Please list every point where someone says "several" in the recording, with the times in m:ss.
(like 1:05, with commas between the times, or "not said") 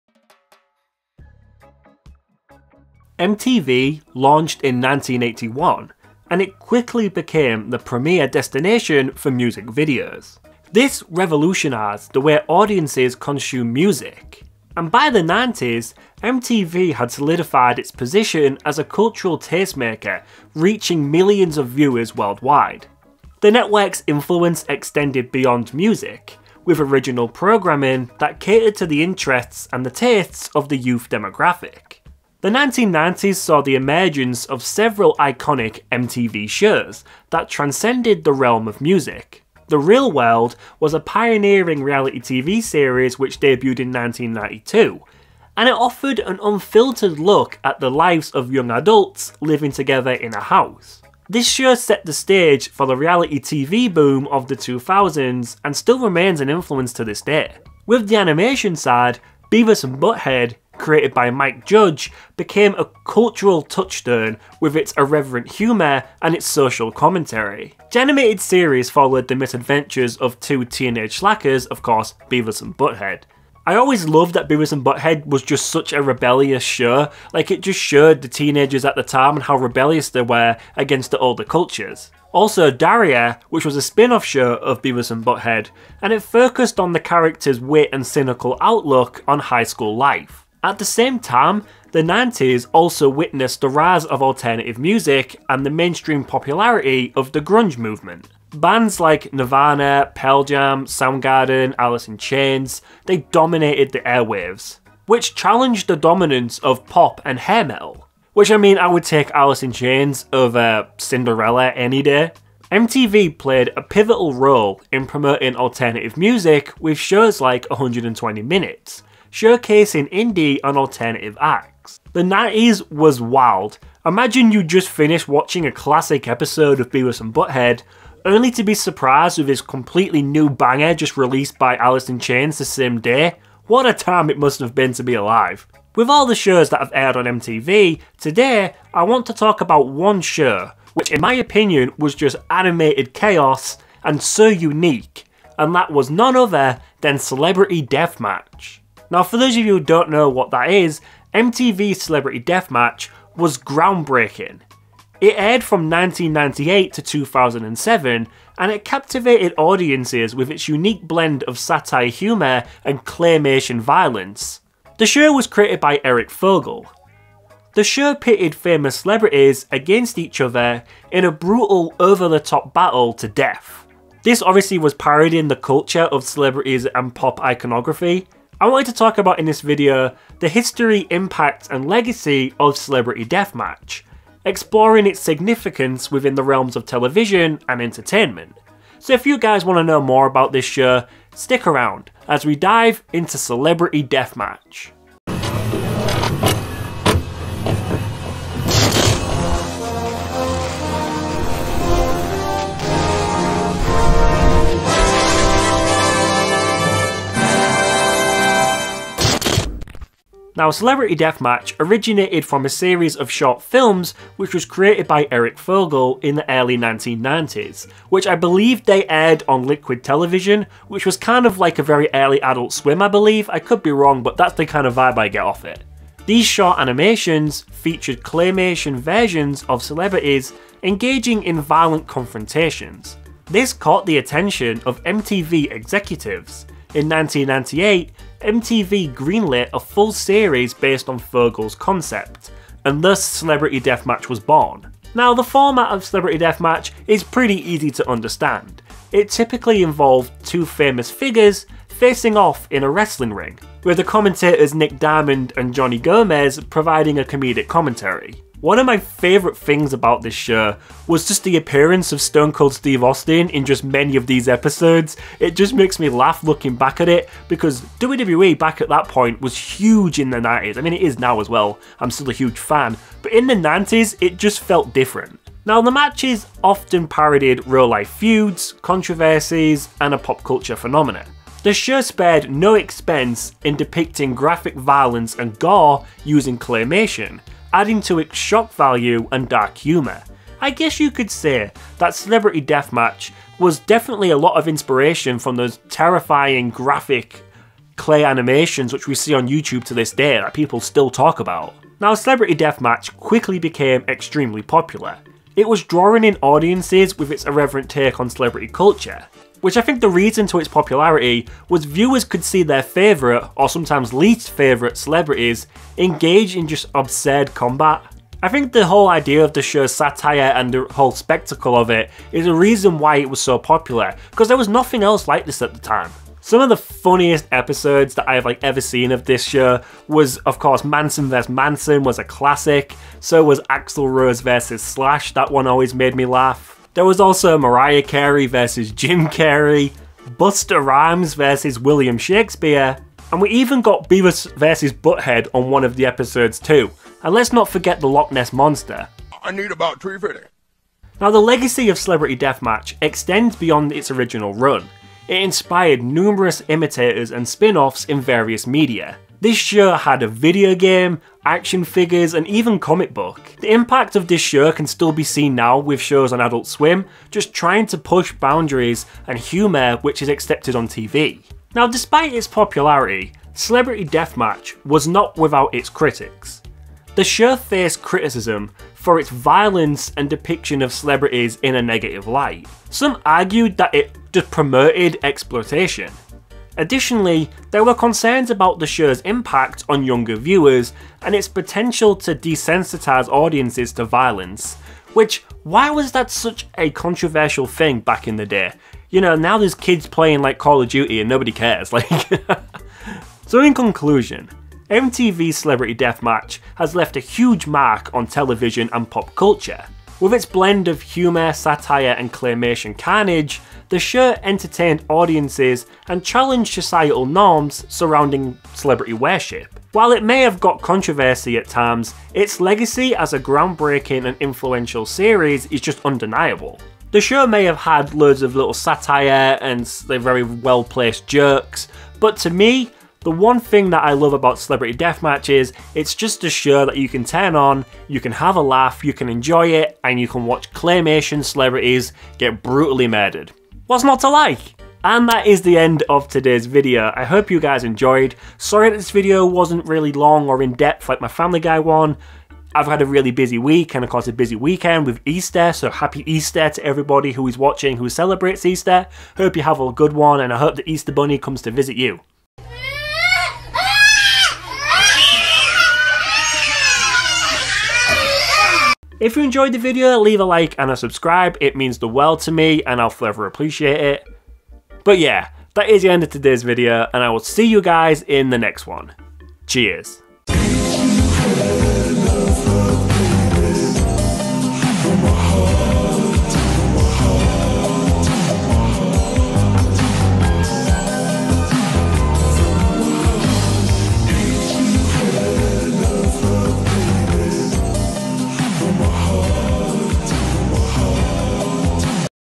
0:34.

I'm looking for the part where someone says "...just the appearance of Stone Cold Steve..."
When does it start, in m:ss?
4:21.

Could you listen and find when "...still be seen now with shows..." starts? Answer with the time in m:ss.
6:04.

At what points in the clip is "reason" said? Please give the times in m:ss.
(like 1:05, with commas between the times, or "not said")
5:10, 5:22.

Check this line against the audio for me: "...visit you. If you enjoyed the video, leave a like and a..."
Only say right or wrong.
right.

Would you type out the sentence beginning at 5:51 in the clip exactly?
Now the legacy of Celebrity Deathmatch extends beyond its original run.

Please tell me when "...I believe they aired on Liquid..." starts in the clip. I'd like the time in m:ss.
3:38.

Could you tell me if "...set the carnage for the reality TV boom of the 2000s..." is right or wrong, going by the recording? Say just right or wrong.
wrong.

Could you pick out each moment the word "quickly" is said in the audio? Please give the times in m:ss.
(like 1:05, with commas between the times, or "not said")
0:06, 5:03.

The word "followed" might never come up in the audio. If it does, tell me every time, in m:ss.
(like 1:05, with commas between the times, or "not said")
1:08.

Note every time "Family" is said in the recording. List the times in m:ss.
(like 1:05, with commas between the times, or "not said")
7:31.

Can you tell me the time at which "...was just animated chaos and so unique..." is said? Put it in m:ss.
2:21.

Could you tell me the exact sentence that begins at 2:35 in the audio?
It aired from 1998 to 2007, and it captivated audiences with its unique blend of satire humour and claymation violence.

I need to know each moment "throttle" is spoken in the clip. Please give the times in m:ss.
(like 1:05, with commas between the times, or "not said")
not said.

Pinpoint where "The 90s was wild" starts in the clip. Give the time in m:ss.
2:02.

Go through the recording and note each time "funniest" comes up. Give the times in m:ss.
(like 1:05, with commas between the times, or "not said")
5:26.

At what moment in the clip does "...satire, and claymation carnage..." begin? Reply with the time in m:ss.
6:51.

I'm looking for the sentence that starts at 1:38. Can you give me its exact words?
Bands like Nirvana, Pearl Jam, Soundgarden, Alice in Chains, they dominated the airwaves, which challenged the dominance of pop and hair metal.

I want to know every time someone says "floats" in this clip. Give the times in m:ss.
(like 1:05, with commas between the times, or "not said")
not said.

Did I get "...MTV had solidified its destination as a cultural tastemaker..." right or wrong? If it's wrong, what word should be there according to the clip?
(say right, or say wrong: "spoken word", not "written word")
wrong: "position", not "destination".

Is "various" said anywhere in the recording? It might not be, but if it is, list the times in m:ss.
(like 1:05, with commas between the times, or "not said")
5:58.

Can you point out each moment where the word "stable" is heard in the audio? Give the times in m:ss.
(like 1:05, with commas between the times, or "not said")
not said.